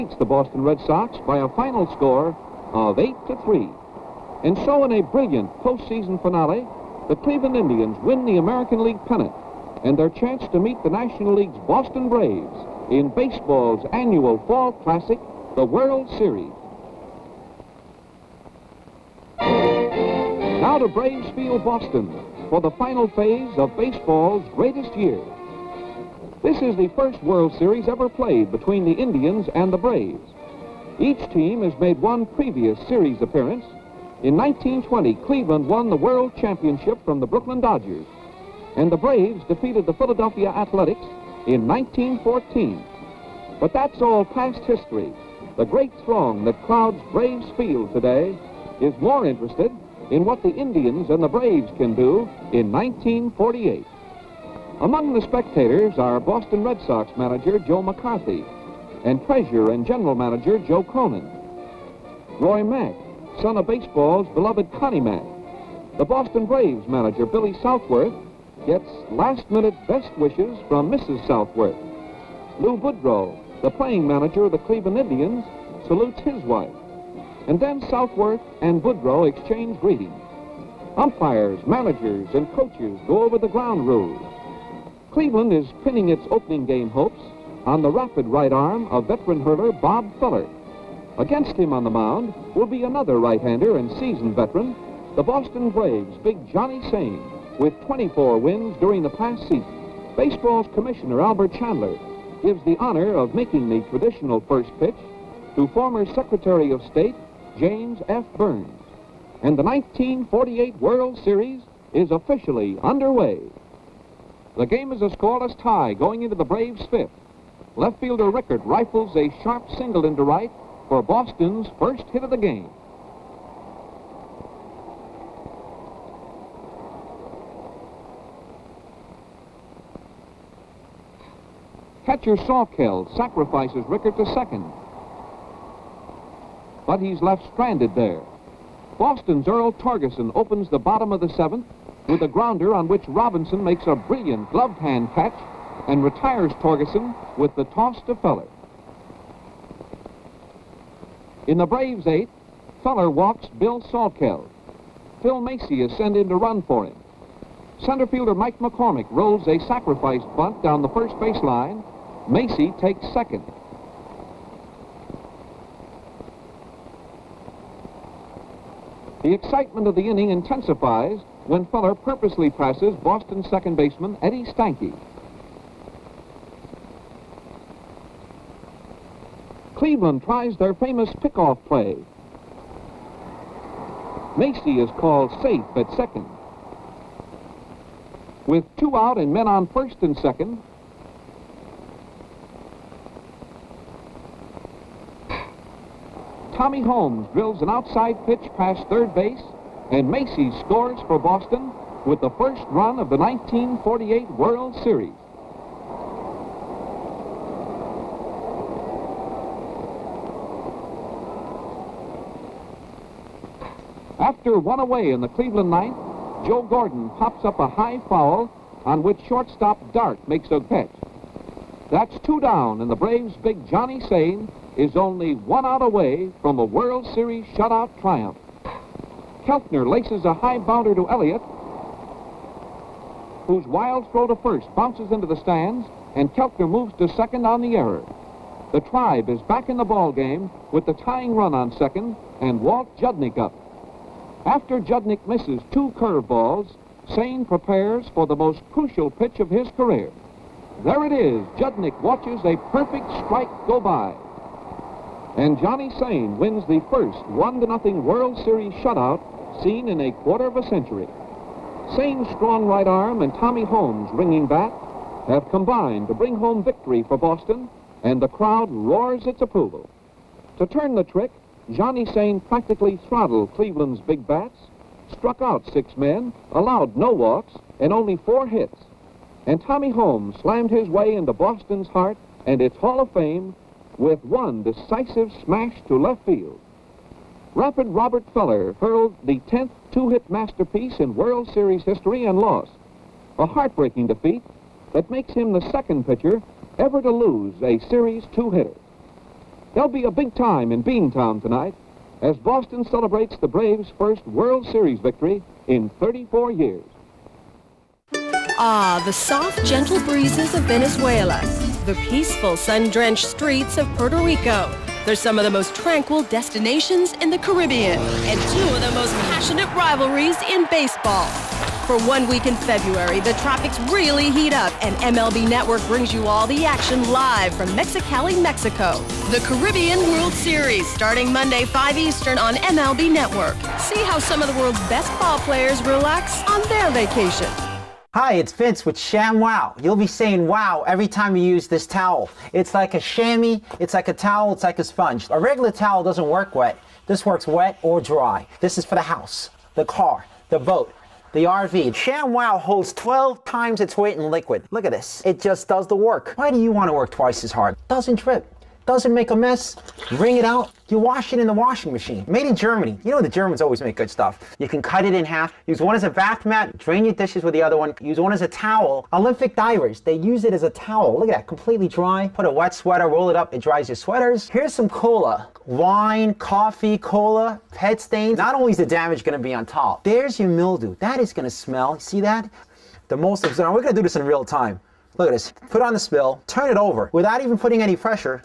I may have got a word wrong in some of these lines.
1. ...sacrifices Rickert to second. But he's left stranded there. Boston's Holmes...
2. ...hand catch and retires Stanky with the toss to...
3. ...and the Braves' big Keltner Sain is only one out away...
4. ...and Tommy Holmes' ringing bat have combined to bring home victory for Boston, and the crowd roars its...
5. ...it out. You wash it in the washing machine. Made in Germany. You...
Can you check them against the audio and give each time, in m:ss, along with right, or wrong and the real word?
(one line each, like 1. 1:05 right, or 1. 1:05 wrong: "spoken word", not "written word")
1. 2:13 wrong: "Earl", not "Holmes"
2. 2:24 wrong: "Torgeson", not "Stanky"
3. 3:42 wrong: "Johnny", not "Keltner"
4. 4:23 right
5. 6:00 right.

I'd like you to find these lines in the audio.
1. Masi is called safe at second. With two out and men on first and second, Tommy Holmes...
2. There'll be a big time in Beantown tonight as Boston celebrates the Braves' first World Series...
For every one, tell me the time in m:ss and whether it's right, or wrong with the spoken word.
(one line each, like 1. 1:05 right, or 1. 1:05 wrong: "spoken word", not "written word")
1. 3:04 right
2. 4:59 right.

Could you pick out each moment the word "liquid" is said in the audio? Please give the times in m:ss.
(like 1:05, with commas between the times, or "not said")
5:54.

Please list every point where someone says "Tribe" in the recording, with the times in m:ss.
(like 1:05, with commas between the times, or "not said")
3:58.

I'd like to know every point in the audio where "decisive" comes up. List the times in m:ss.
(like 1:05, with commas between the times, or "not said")
4:44.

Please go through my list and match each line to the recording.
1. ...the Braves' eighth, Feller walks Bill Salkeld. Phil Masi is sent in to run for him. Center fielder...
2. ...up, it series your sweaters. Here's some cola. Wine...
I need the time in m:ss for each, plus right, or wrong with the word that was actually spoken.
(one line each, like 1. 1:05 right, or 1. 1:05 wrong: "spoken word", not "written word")
1. 2:31 right
2. 6:13 wrong: "dries", not "series".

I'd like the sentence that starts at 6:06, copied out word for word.
Drain your dishes with the other one.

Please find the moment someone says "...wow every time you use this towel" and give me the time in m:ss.
5:40.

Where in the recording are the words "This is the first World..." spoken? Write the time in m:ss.
0:26.